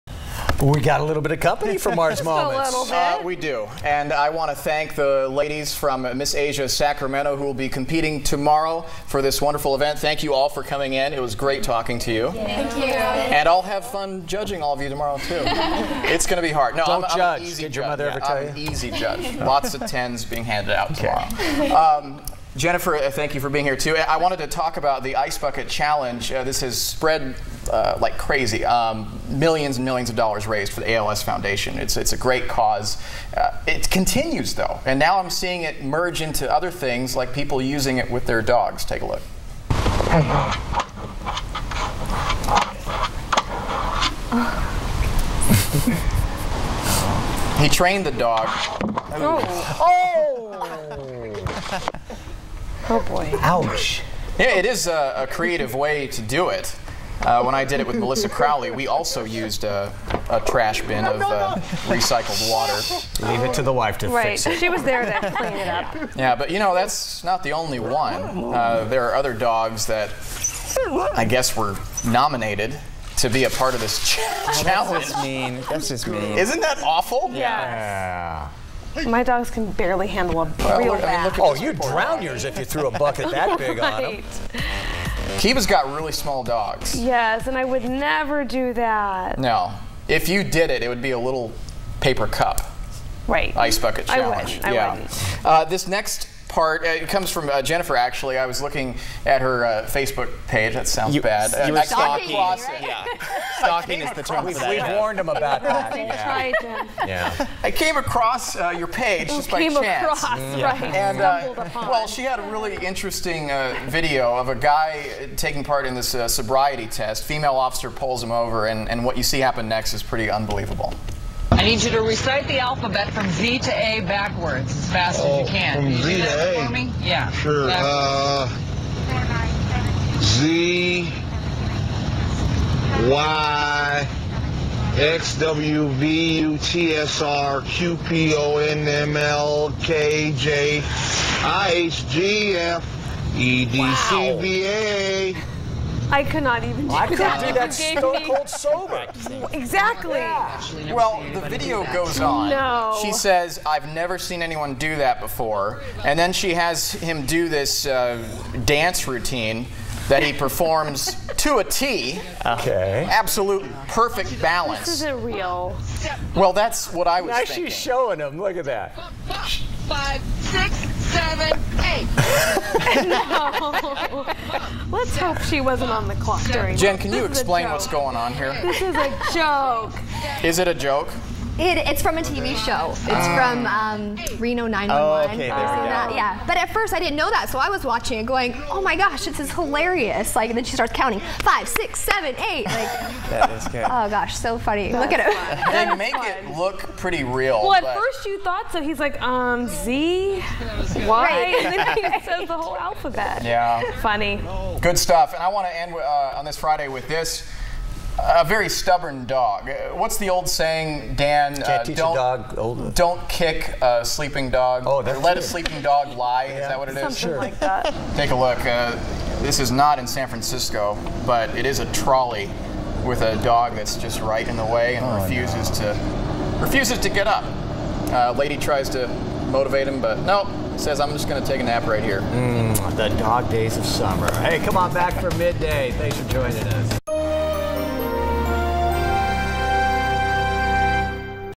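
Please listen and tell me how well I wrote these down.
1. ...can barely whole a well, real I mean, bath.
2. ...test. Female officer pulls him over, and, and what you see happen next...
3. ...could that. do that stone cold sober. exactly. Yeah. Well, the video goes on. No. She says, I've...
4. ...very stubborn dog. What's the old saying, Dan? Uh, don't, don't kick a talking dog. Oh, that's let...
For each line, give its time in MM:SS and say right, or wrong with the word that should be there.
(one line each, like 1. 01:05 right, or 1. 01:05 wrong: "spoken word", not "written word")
1. 01:19 wrong: "handle", not "whole"
2. 01:56 right
3. 02:27 right
4. 03:28 wrong: "sleeping", not "talking".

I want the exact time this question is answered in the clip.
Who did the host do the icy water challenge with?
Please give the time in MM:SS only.
00:57.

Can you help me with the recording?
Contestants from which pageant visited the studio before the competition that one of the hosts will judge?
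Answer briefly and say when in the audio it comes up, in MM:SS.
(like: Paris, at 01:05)
Miss Asia Sacramento, at 00:06.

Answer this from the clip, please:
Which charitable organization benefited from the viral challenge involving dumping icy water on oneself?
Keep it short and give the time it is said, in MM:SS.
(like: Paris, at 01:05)
ALS Foundation, at 00:30.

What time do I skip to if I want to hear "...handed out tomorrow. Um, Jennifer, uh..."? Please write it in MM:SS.
00:20.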